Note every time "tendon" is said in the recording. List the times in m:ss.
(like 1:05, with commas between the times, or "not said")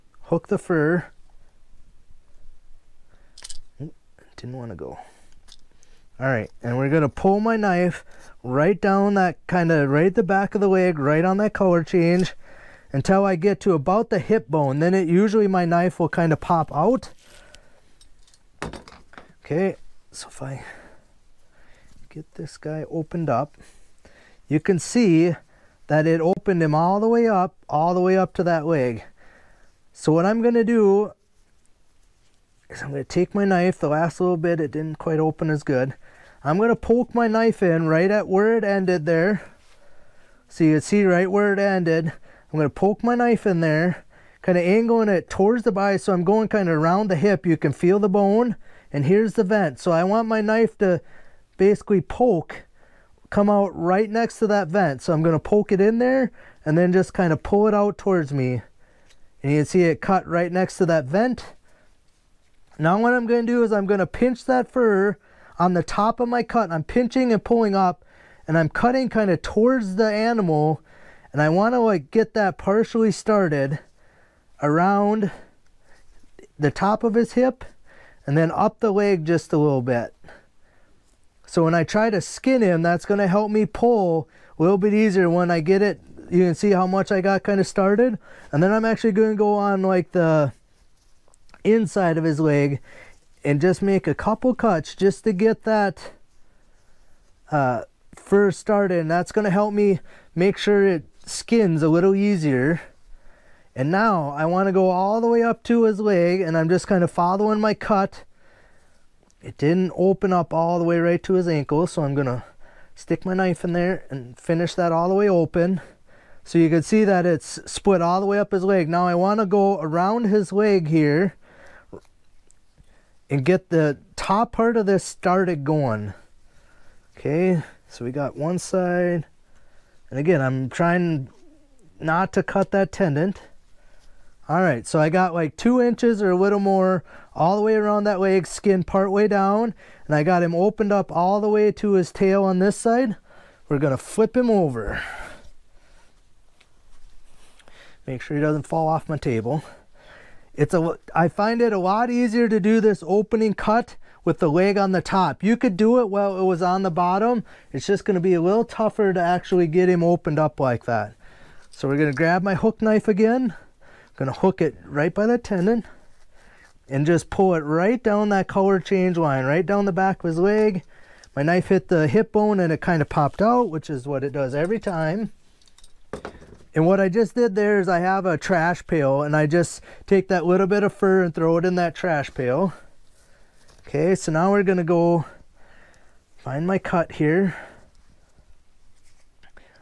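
2:12, 2:45.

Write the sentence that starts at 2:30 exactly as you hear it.
It's a, I find it a lot easier to do this opening cut with the leg on the top.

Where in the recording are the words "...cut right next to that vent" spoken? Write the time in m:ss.
1:00.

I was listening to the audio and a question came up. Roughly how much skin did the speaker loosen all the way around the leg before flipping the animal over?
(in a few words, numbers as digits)
2 inches.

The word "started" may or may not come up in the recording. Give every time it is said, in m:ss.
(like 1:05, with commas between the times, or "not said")
1:13, 1:27, 1:38, 2:05.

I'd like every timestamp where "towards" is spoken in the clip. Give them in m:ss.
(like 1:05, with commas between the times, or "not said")
0:45, 0:57, 1:09.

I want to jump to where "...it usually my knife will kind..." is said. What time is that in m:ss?
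0:14.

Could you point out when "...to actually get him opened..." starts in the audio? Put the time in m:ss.
2:39.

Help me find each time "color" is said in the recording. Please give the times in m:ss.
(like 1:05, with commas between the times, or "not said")
0:11, 2:48.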